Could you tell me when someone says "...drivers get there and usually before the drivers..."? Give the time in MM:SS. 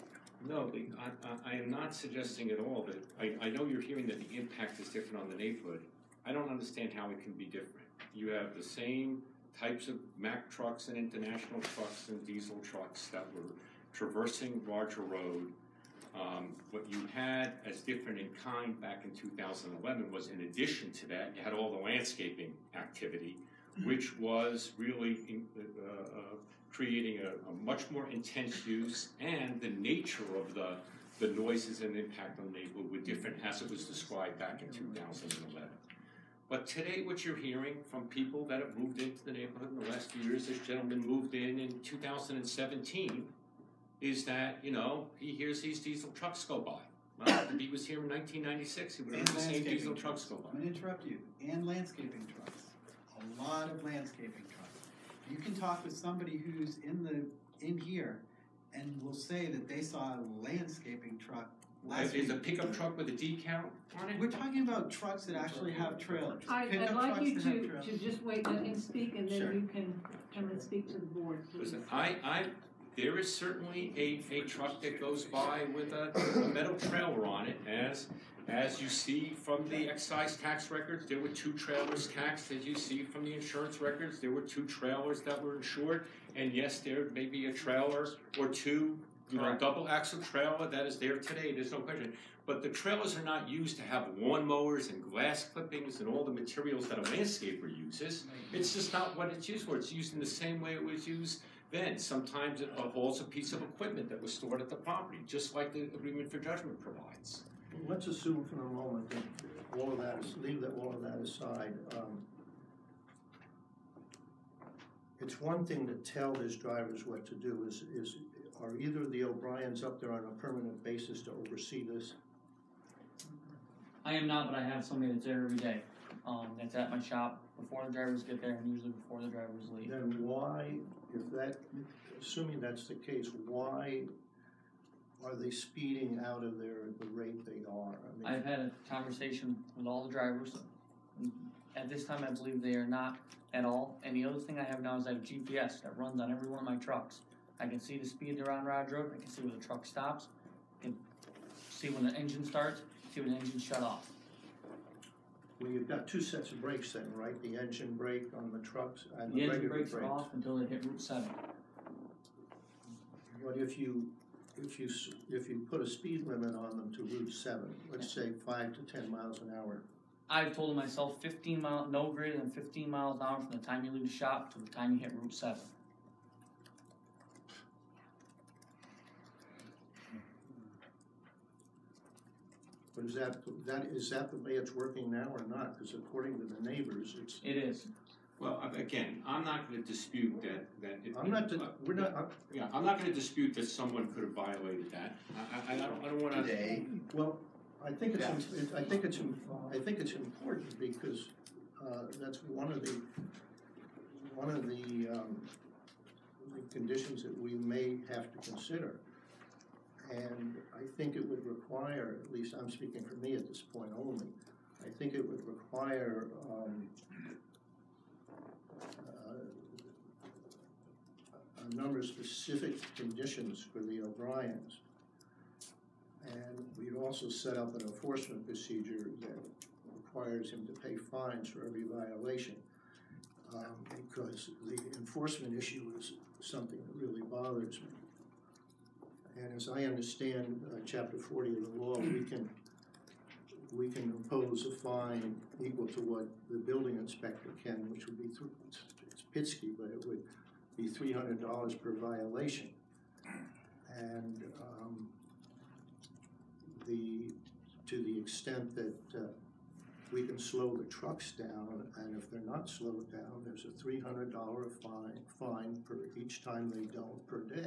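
02:07.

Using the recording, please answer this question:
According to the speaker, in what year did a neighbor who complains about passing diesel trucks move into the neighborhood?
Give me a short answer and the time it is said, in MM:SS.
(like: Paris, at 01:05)
2017, at 00:41.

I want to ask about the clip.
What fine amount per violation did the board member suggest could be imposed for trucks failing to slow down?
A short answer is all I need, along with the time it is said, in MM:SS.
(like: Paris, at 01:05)
$300, at 04:10.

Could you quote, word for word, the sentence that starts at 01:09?
then you can come and speak to the board, please.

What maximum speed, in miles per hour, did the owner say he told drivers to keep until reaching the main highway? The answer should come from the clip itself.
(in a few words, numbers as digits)
15.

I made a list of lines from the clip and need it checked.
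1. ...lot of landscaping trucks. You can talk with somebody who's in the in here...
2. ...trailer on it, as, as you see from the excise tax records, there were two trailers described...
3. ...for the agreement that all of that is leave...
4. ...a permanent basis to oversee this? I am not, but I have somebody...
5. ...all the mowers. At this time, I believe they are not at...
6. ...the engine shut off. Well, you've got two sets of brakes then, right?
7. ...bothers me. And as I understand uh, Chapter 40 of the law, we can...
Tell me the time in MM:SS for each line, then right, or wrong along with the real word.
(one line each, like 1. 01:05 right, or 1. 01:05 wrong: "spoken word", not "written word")
1. 00:53 right
2. 01:16 wrong: "taxed", not "described"
3. 01:48 wrong: "moment", not "agreement"
4. 02:00 right
5. 02:19 wrong: "drivers", not "mowers"
6. 02:33 right
7. 03:57 right.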